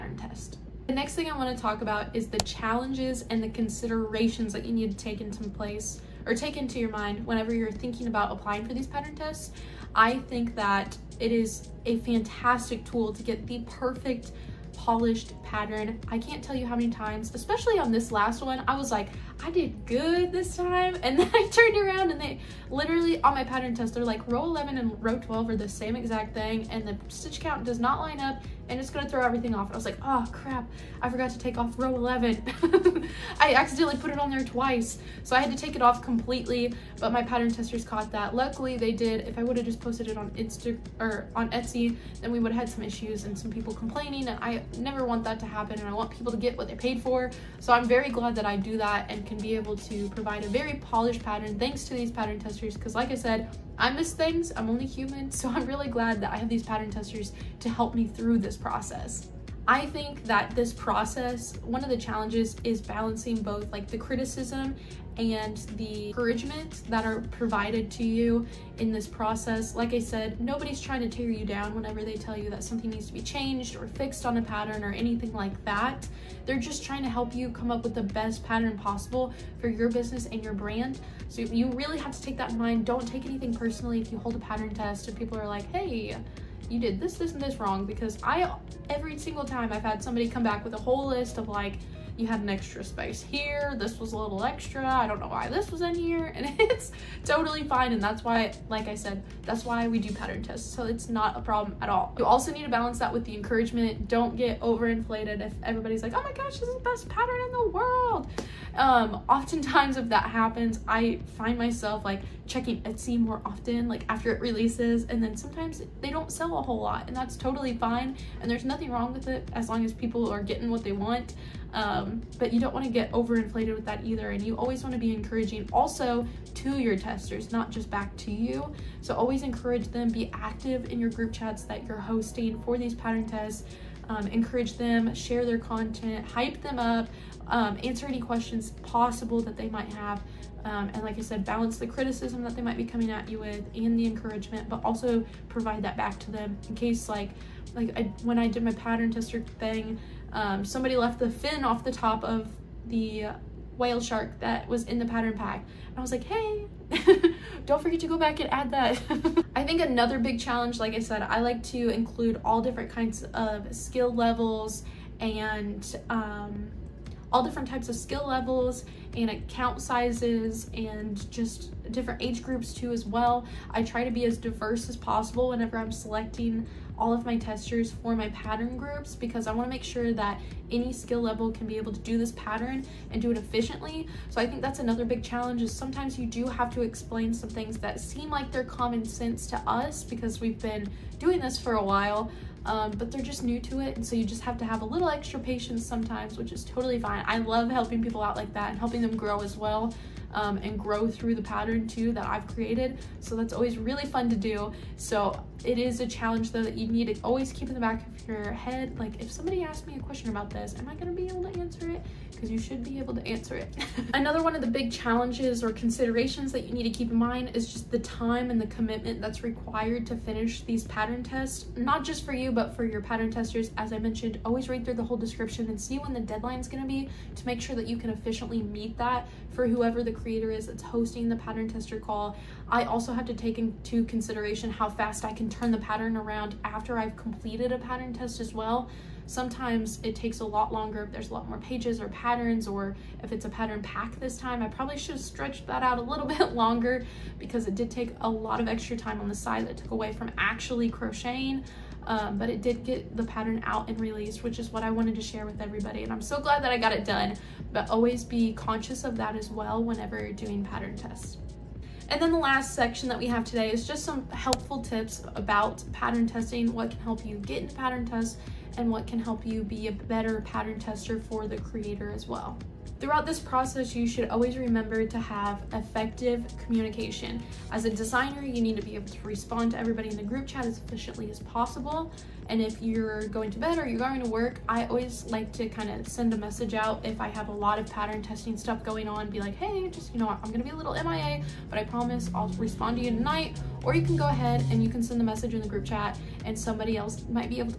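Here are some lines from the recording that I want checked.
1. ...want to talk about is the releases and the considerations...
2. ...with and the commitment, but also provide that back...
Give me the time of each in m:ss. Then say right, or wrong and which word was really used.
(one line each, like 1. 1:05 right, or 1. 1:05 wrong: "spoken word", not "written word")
1. 0:01 wrong: "challenges", not "releases"
2. 2:23 wrong: "encouragement", not "commitment".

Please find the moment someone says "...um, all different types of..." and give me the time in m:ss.
2:46.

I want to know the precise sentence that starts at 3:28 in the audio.
Like if somebody asks me a question about this, am I gonna be able to answer it?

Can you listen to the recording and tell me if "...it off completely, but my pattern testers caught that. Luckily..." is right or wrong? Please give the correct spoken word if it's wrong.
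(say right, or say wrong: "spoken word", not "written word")
right.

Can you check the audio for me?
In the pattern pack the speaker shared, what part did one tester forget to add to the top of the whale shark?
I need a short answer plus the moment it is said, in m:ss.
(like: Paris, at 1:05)
The fin, at 2:31.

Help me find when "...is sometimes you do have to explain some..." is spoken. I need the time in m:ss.
3:05.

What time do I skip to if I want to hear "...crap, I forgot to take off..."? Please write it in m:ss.
0:30.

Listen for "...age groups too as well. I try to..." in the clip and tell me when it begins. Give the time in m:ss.
2:52.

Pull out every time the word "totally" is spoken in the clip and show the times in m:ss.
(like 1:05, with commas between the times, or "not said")
1:37, 1:57, 3:16.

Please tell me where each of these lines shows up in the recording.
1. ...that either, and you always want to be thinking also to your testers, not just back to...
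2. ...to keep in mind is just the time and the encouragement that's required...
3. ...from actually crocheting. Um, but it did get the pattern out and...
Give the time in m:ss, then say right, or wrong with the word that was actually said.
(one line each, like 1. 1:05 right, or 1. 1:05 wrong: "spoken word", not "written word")
1. 2:03 wrong: "encouraging", not "thinking"
2. 3:36 wrong: "commitment", not "encouragement"
3. 4:10 right.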